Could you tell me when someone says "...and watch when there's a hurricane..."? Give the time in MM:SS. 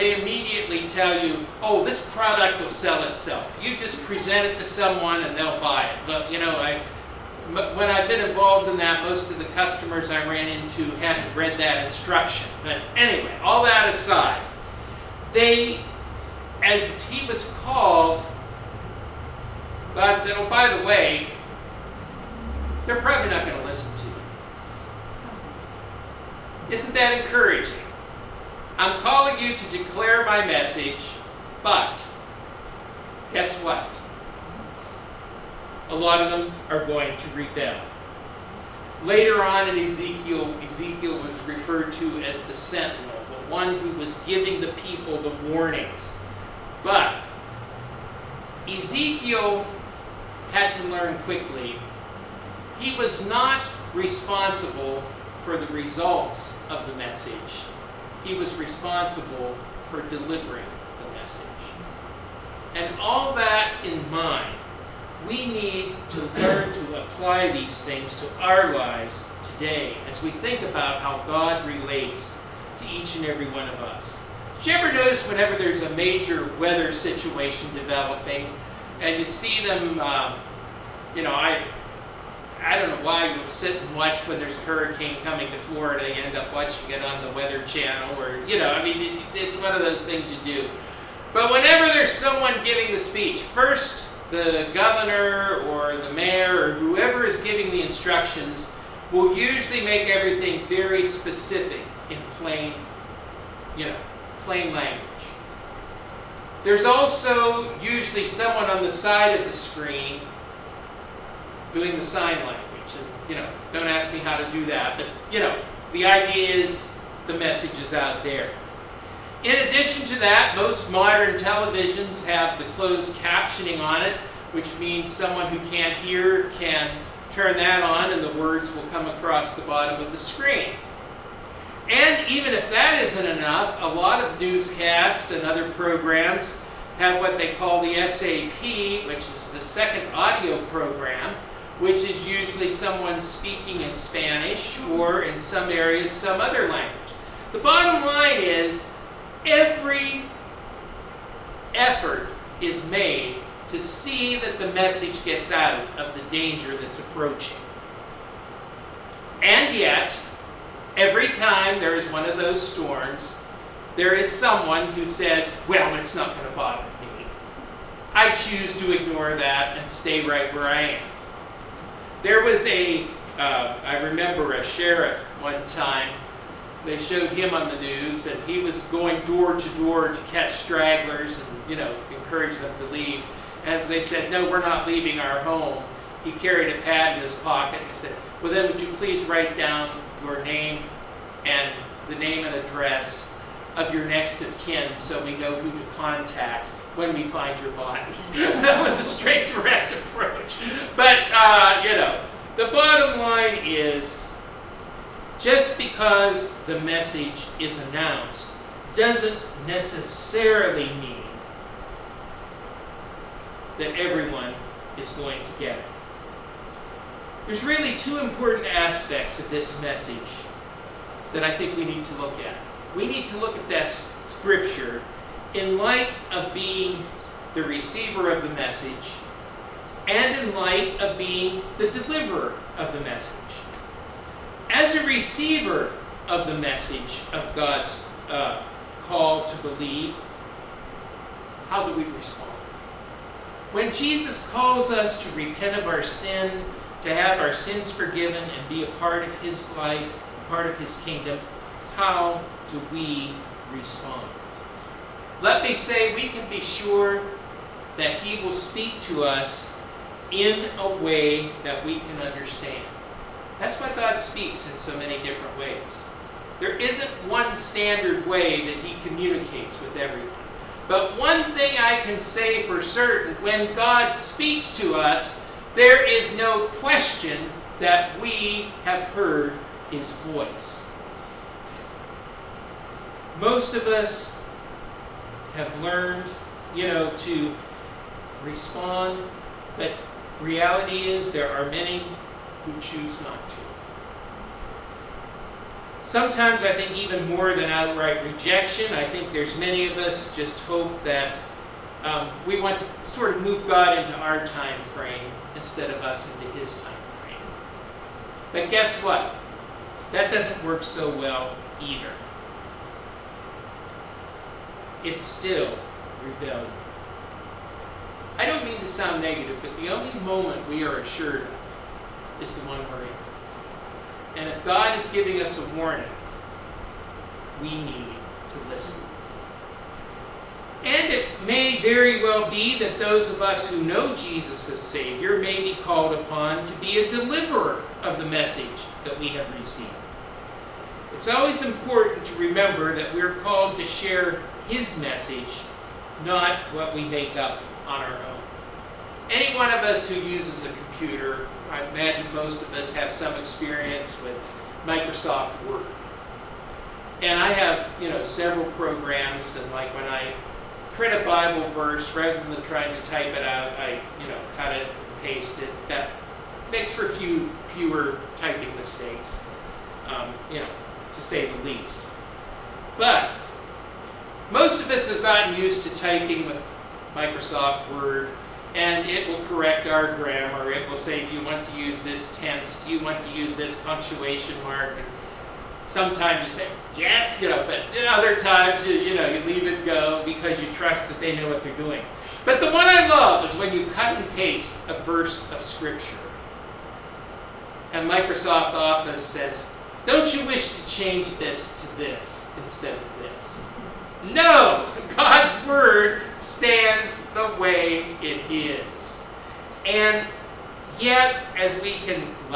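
01:23.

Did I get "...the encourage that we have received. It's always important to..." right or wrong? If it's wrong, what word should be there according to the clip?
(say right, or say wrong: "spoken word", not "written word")
wrong: "message", not "encourage".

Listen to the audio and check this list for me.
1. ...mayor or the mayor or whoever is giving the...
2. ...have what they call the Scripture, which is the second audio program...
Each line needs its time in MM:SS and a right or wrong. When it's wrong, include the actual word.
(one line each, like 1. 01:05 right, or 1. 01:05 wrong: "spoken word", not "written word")
1. 01:34 wrong: "governor", not "mayor"
2. 02:16 wrong: "SAP", not "Scripture".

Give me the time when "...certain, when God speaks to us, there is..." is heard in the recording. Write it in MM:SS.
04:32.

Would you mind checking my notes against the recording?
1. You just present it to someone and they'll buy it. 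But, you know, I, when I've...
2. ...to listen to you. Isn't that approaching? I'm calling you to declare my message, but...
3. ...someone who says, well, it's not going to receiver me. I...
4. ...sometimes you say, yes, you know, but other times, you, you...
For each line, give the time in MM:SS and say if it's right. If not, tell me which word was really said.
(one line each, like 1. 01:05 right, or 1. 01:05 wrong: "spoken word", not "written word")
1. 00:03 right
2. 00:23 wrong: "encouraging", not "approaching"
3. 02:44 wrong: "bother", not "receiver"
4. 06:25 right.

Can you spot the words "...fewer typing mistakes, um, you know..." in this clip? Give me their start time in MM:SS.
06:07.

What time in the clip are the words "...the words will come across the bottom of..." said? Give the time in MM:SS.
02:08.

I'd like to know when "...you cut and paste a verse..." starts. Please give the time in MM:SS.
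06:33.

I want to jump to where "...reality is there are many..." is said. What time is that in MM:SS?
04:50.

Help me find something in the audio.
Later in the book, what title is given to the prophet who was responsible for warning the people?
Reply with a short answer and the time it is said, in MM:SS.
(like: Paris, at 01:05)
the sentinel, at 00:42.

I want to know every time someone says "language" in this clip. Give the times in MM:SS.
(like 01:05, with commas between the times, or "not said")
01:44, 01:52, 02:26.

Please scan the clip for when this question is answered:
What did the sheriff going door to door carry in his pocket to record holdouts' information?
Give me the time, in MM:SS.
03:06.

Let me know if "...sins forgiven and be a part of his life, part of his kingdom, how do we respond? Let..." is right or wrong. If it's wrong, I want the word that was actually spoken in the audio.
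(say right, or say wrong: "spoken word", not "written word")
right.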